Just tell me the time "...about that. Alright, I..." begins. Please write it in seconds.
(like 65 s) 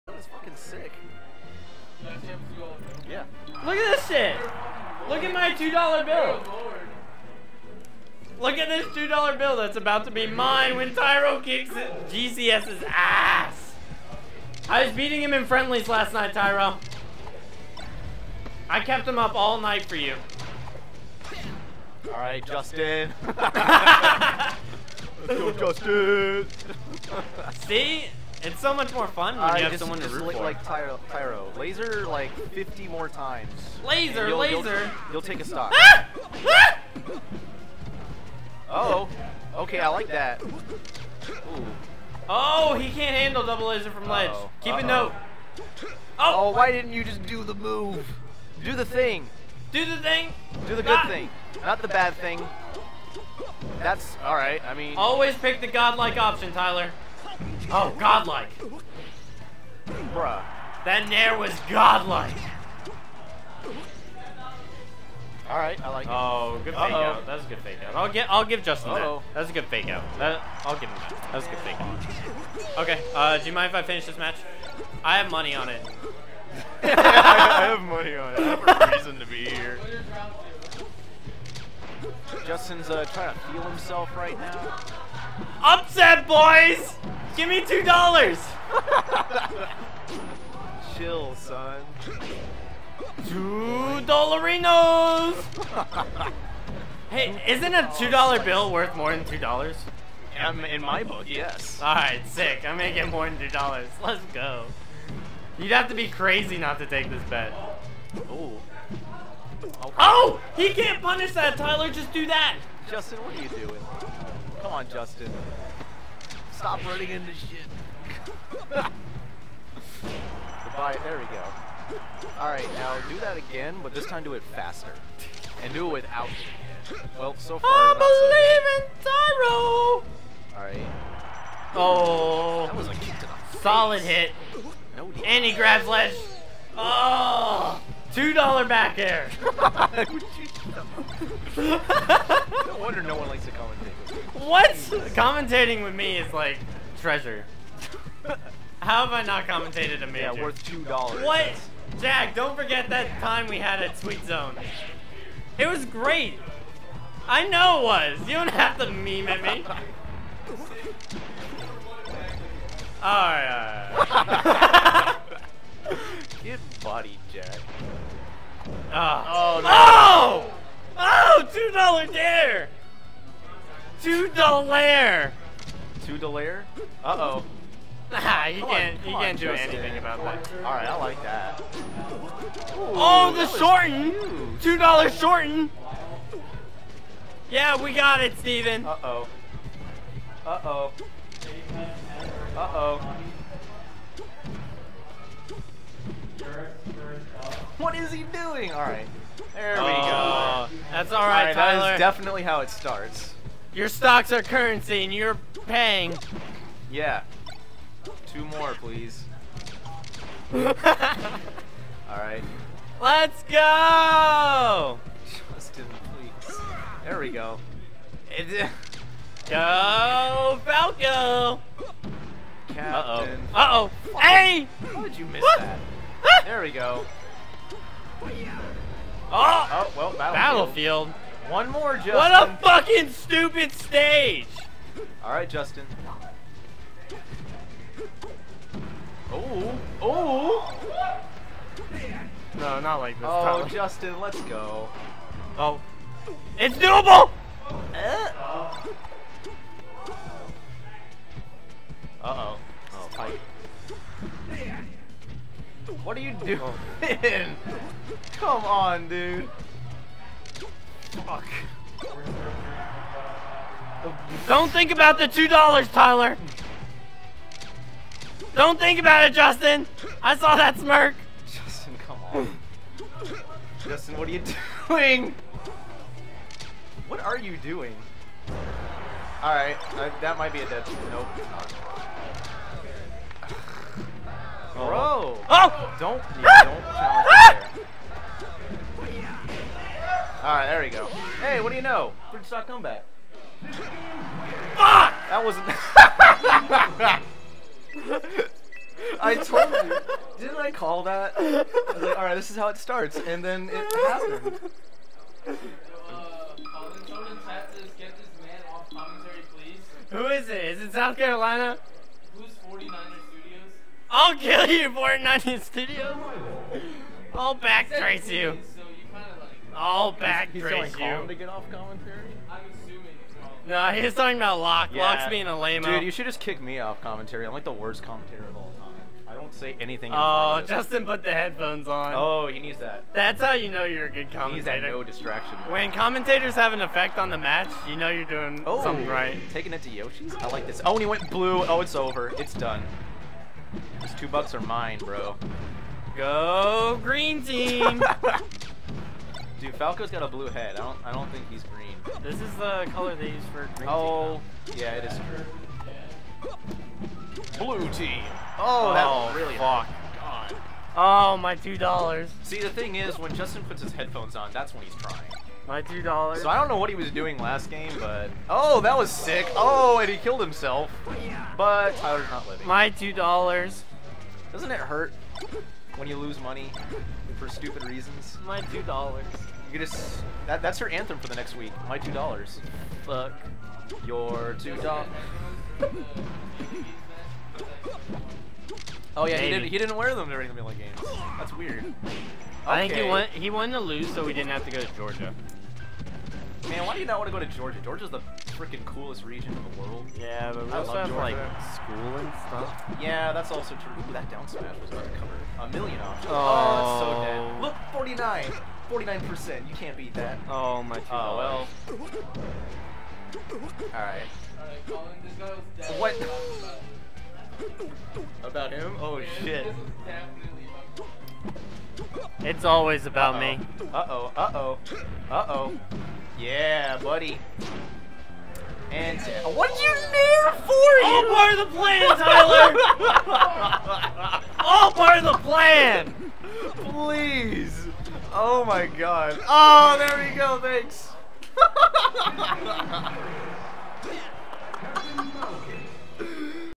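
179 s.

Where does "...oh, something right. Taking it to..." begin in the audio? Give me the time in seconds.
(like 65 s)
338 s.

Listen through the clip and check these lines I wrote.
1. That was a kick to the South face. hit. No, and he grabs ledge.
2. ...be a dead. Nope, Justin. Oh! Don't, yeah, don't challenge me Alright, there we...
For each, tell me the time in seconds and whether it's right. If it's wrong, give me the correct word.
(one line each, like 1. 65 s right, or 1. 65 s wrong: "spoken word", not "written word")
1. 132 s wrong: "Solid", not "South"
2. 280 s wrong: "Bro", not "Justin".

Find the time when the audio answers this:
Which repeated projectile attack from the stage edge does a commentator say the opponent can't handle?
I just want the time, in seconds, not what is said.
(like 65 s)
43 s.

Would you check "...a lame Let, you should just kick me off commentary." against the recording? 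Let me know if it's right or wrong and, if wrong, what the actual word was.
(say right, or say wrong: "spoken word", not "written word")
wrong: "Dude", not "Let".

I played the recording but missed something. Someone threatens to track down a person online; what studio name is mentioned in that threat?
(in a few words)
Fortnite Studios.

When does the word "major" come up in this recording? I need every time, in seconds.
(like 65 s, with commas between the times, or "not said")
150 s.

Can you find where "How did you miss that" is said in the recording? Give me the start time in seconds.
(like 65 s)
224 s.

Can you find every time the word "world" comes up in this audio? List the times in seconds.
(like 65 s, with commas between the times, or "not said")
399 s.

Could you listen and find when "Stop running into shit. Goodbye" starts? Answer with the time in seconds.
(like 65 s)
116 s.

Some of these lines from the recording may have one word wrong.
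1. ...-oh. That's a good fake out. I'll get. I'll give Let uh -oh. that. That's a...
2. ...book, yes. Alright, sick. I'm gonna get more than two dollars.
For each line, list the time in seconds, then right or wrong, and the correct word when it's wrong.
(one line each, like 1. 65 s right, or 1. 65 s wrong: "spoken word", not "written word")
1. 66 s wrong: "Justin", not "Let"
2. 101 s right.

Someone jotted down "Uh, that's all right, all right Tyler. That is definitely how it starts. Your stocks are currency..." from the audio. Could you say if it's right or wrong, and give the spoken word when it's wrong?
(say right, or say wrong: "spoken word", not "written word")
right.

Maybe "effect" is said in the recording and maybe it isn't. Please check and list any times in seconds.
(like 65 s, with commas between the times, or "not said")
336 s.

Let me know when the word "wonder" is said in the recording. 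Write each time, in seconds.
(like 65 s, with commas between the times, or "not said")
142 s.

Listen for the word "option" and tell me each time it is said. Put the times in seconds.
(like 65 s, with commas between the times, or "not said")
56 s, 406 s.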